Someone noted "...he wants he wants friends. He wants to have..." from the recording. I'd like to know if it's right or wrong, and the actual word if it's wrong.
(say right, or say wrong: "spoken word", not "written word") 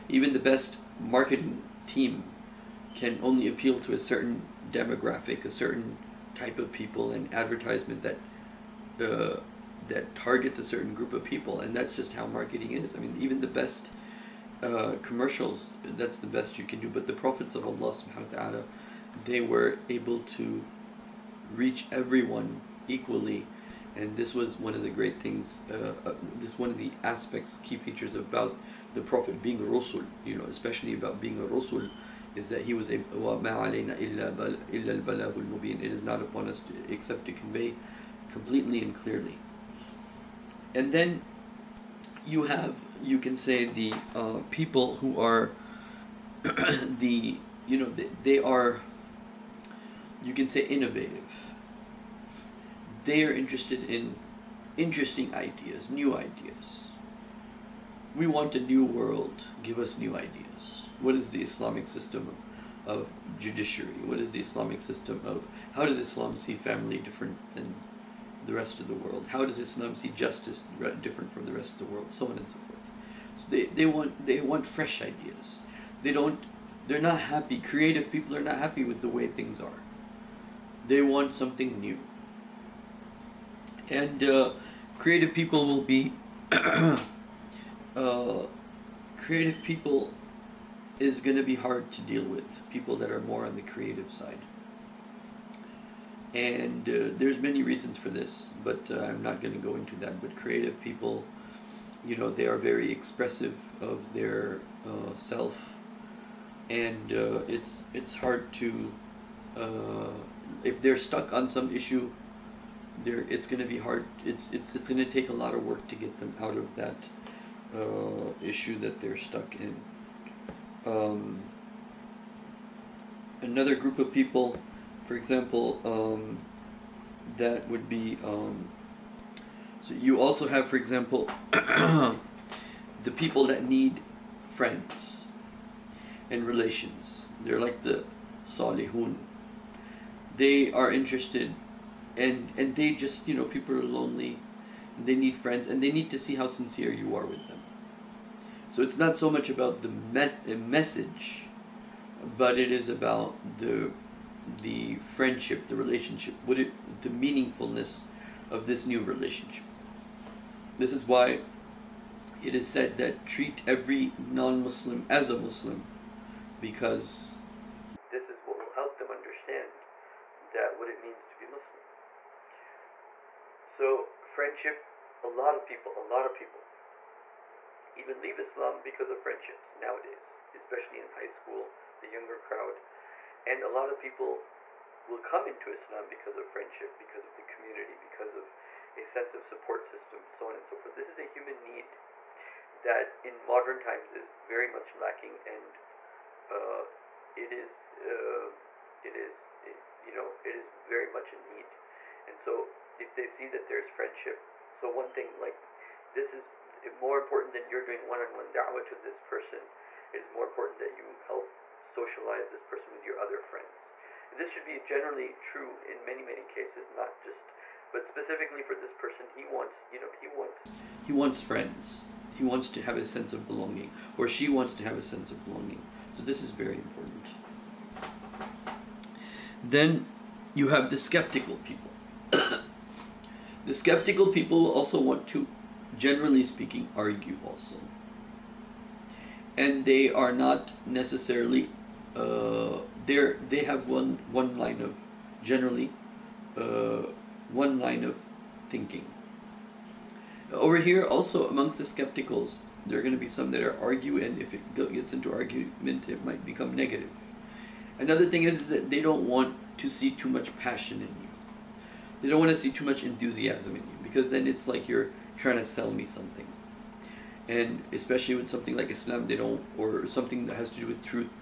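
right.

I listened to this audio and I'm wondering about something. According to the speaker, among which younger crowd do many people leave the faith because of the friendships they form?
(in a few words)
high school.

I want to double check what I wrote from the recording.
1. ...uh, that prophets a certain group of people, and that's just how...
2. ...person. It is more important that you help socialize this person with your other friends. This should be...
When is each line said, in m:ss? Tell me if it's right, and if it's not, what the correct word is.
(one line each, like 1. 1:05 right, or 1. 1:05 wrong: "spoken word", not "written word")
1. 0:09 wrong: "targets", not "prophets"
2. 3:29 right.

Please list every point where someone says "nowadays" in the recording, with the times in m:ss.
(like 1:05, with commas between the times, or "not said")
2:59.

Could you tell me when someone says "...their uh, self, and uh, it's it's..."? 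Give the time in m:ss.
1:44.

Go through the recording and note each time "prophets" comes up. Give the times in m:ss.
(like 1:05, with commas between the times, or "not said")
0:17, 0:29.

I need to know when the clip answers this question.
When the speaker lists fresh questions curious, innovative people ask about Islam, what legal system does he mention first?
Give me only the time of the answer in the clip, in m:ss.
1:03.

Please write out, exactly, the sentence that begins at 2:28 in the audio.
So it's not so much about the me- message, but it is about the the friendship, the relationship?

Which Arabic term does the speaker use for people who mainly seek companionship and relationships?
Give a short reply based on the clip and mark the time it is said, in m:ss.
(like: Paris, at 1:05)
salihun, at 2:18.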